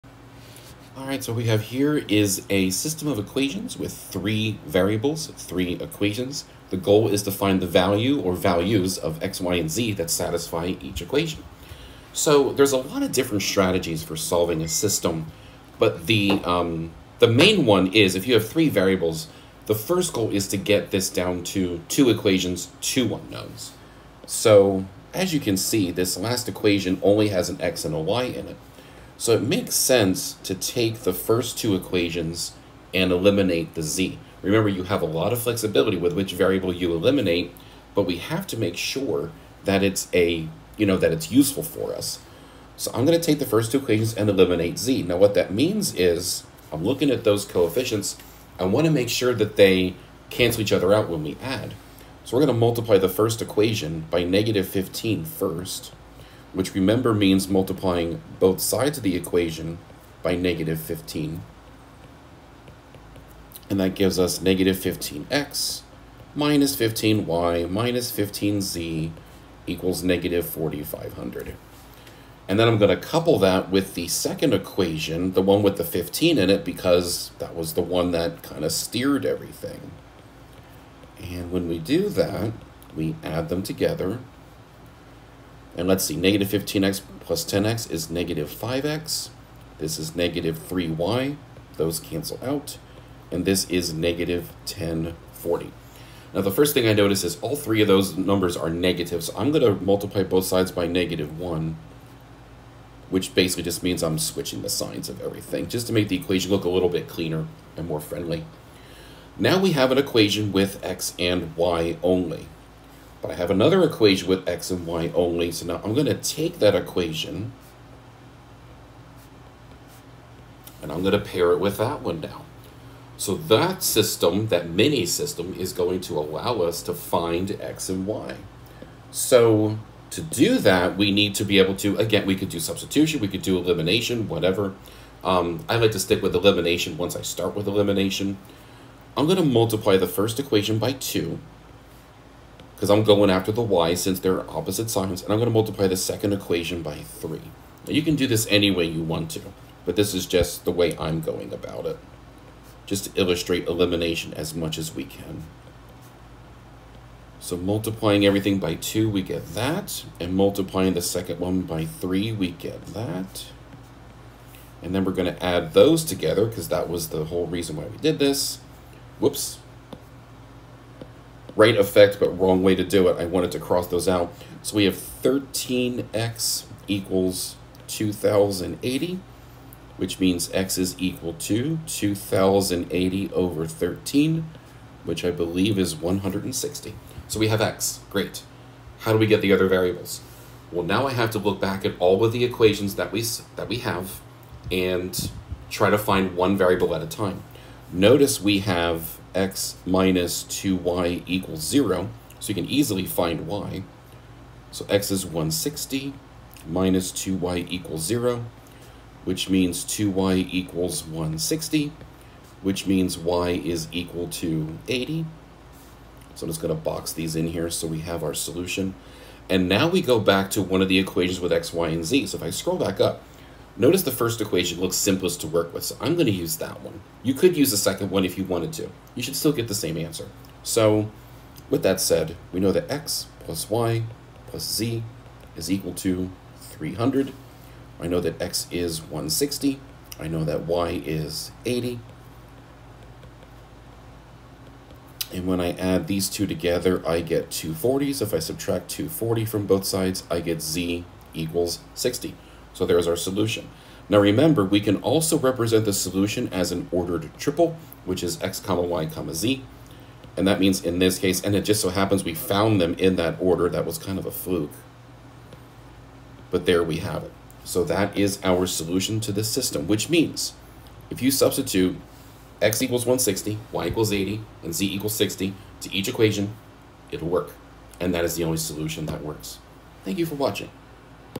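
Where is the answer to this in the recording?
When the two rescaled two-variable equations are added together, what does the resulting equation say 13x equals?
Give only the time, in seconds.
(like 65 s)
174 s.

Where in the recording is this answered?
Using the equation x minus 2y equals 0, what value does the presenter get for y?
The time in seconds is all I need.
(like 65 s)
213 s.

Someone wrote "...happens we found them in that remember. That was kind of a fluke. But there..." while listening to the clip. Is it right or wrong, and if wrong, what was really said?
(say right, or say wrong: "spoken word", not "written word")
wrong: "order", not "remember".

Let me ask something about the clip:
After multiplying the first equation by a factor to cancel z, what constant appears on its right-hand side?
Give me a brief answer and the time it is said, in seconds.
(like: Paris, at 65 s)
-4,500, at 70 s.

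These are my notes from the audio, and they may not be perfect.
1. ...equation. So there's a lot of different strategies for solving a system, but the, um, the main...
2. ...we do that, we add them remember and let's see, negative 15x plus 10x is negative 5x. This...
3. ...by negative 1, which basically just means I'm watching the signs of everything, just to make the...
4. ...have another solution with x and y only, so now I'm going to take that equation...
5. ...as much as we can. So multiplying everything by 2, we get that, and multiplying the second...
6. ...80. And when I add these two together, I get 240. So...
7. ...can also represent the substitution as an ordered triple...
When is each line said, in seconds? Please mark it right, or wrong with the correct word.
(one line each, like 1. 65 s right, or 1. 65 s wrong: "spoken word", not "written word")
1. 11 s right
2. 81 s wrong: "together", not "remember"
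3. 100 s wrong: "switching", not "watching"
4. 113 s wrong: "equation", not "solution"
5. 154 s right
6. 241 s right
7. 254 s wrong: "solution", not "substitution".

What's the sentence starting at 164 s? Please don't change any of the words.
And then we're going to add those together, because that was the whole reason why we did this.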